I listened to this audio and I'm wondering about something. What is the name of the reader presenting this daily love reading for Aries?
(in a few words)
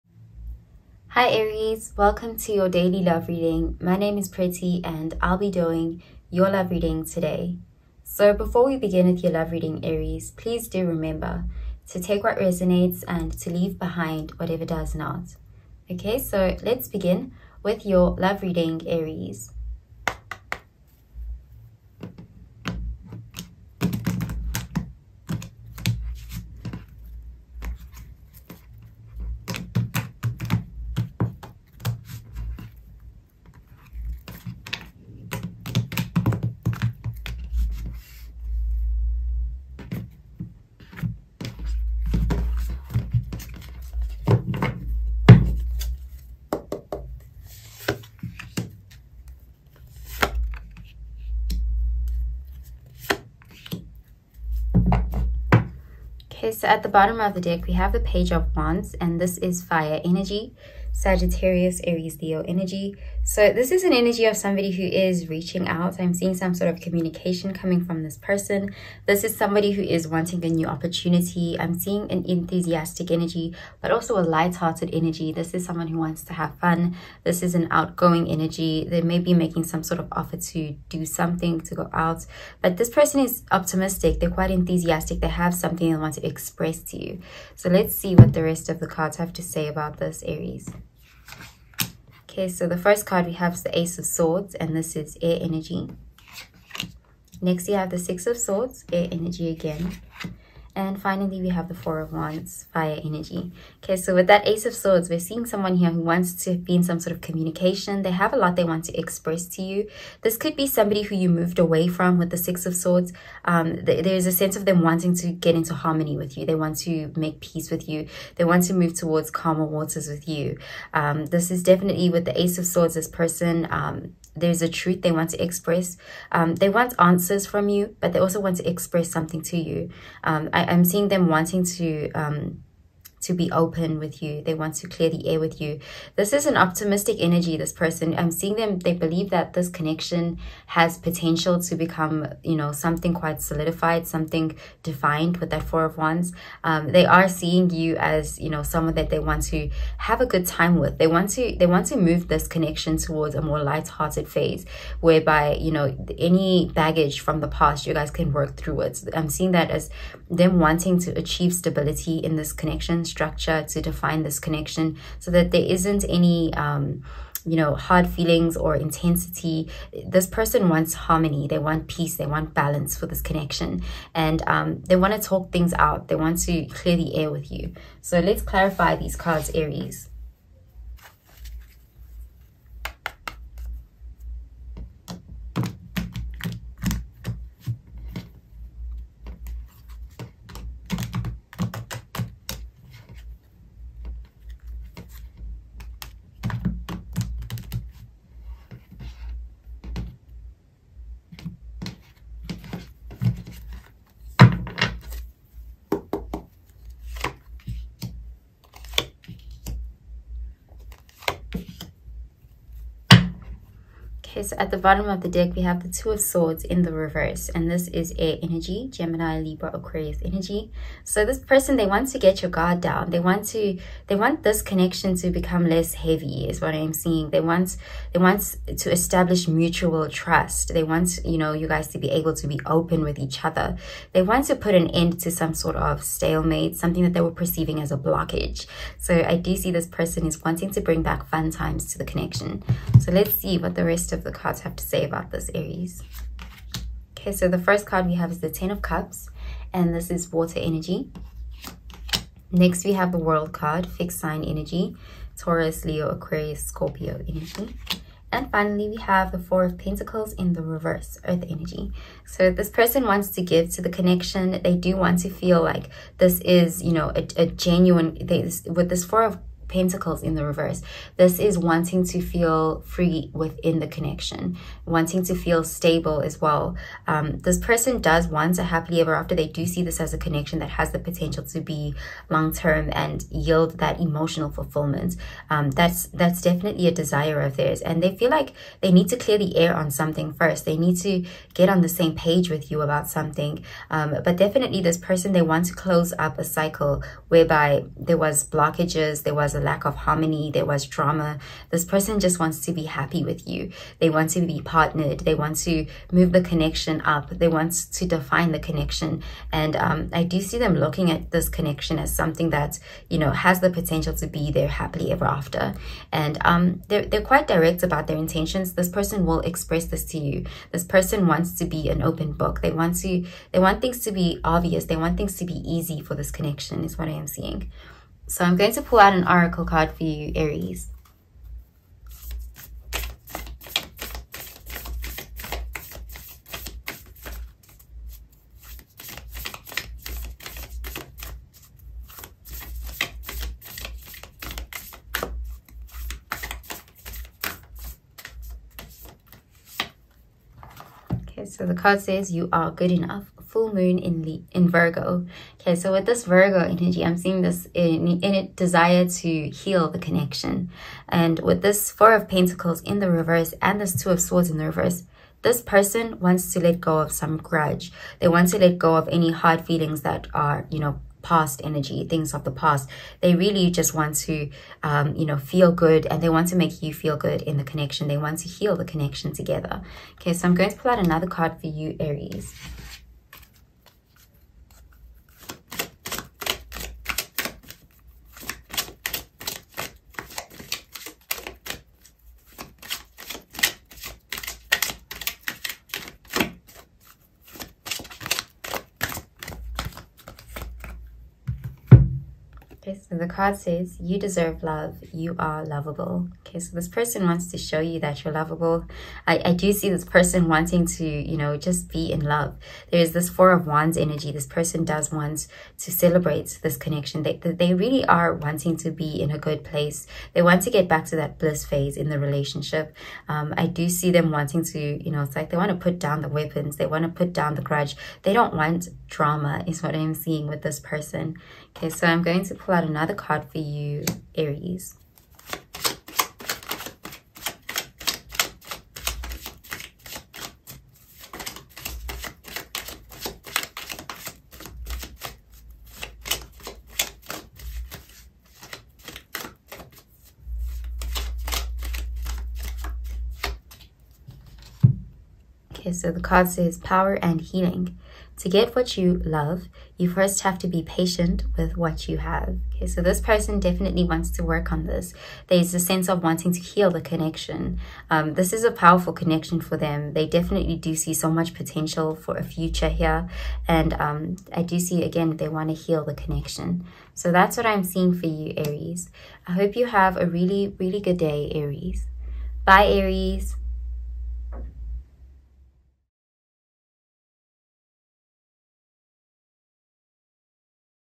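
Pretty.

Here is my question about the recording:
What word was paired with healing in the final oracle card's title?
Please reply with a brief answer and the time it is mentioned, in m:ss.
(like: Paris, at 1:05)
Power, at 7:36.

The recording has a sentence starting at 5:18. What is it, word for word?
This person will express this to you.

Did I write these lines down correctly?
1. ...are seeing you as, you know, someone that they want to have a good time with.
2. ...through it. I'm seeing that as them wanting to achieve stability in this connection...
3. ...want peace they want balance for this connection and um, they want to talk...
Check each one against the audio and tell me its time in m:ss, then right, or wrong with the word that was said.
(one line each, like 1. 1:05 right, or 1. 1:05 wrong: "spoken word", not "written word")
1. 2:27 right
2. 2:38 right
3. 2:51 right.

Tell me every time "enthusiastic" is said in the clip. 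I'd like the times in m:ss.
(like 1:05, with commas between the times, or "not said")
1:12, 1:24.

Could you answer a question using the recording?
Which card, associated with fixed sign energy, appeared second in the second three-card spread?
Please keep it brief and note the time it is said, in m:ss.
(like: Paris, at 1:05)
The World, at 4:13.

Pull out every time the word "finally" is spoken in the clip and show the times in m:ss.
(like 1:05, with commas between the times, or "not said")
1:41, 4:18.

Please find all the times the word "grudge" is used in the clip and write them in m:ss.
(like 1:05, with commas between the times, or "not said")
6:07, 7:07.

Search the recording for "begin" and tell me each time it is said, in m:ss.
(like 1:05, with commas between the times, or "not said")
0:08, 0:16.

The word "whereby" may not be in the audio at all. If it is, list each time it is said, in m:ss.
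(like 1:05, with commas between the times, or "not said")
2:34, 4:57.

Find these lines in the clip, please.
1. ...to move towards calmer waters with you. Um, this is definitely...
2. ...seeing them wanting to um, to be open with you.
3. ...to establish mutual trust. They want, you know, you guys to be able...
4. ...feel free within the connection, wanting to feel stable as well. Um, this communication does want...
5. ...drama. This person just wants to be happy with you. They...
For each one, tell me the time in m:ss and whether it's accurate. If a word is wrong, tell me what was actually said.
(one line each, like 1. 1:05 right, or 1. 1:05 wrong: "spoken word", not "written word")
1. 1:58 right
2. 2:10 right
3. 3:48 right
4. 4:32 wrong: "person", not "communication"
5. 5:00 right.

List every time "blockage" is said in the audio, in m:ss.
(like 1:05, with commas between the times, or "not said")
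3:57, 4:58.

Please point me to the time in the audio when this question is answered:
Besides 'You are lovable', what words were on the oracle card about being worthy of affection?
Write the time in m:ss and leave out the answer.
6:44.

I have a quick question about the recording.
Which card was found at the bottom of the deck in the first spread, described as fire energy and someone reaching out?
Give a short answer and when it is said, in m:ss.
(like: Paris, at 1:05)
Page of Wands, at 0:58.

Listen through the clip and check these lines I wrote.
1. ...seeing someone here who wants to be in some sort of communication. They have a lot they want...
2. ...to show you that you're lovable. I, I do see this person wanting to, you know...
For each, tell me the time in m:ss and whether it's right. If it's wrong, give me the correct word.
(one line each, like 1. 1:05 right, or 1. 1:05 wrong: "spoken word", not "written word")
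1. 1:45 right
2. 6:47 right.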